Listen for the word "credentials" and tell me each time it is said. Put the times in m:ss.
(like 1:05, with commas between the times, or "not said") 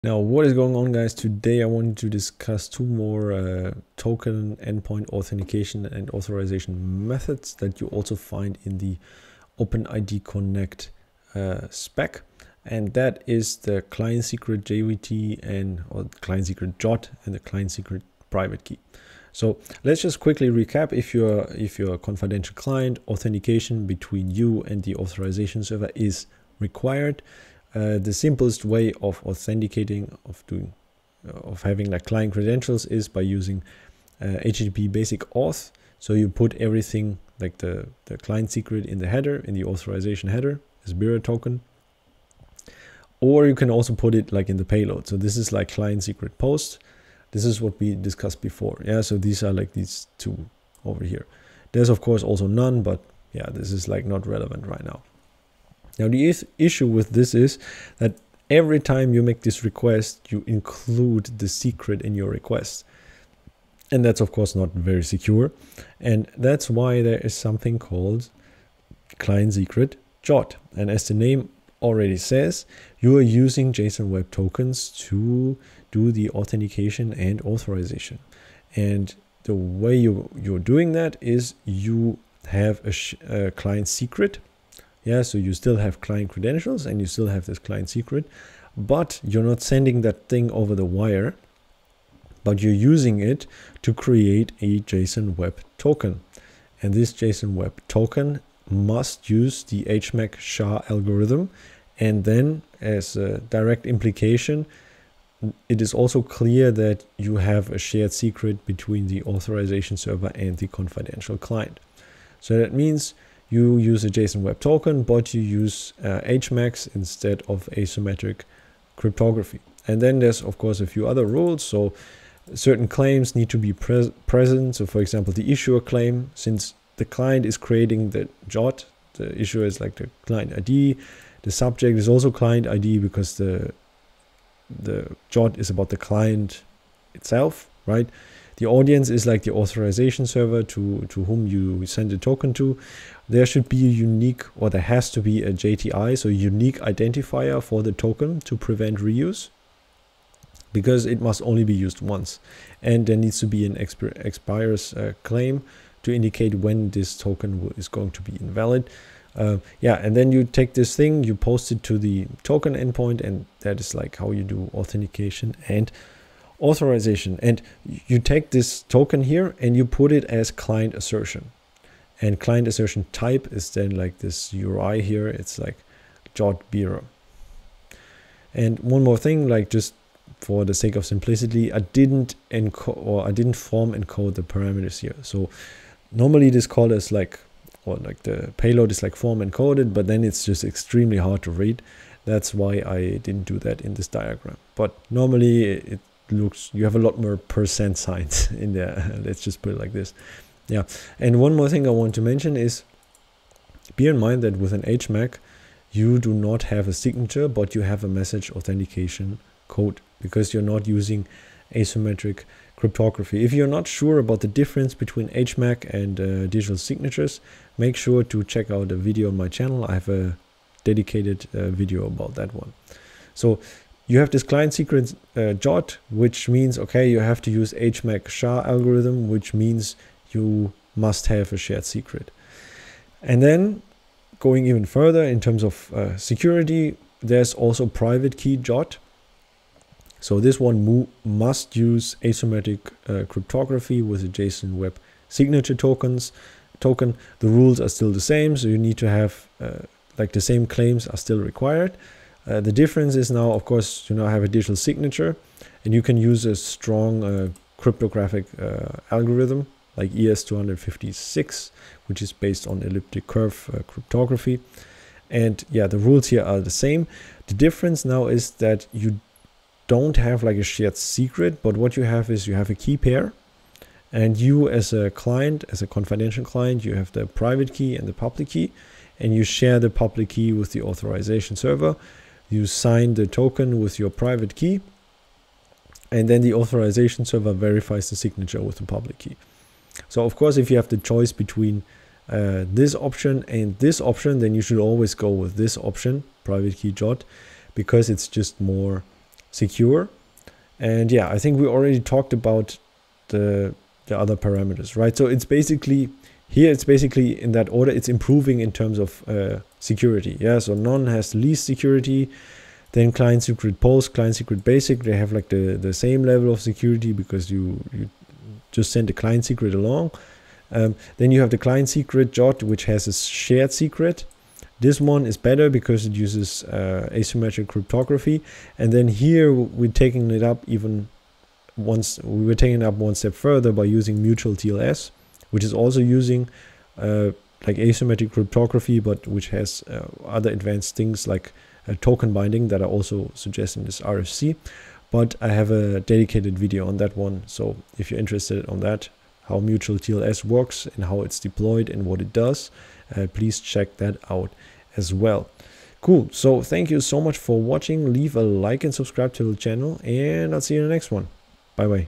0:32, 1:26.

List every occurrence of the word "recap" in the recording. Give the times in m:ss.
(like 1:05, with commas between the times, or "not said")
0:20.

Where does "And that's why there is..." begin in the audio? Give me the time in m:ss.
1:05.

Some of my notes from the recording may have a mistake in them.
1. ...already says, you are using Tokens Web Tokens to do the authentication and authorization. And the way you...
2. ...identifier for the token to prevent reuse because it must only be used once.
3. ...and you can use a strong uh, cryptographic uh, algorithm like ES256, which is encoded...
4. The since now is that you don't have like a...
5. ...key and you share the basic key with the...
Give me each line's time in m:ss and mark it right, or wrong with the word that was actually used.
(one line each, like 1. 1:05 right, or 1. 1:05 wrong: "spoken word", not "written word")
1. 1:11 wrong: "JSON", not "Tokens"
2. 2:26 right
3. 4:15 wrong: "based", not "encoded"
4. 4:27 wrong: "difference", not "since"
5. 4:38 wrong: "public", not "basic".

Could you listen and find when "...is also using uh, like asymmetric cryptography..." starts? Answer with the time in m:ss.
5:35.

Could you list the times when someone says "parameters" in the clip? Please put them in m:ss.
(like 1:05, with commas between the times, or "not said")
3:04, 5:04.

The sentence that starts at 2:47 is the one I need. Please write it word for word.
And you take this token here and you put it as client assertion.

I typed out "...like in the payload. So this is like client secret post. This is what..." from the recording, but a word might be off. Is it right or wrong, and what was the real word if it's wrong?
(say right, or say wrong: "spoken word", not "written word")
right.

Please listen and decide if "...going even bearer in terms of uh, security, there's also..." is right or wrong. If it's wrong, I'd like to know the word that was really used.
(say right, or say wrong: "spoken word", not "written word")
wrong: "further", not "bearer".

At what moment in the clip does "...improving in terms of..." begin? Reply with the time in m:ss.
5:08.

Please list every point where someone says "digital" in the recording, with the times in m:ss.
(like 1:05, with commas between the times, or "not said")
3:36, 4:14.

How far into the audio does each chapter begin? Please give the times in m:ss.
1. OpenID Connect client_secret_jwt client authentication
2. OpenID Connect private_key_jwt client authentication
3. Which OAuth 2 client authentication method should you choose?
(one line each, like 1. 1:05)
1. 1:10
2. 3:53
3. 5:01.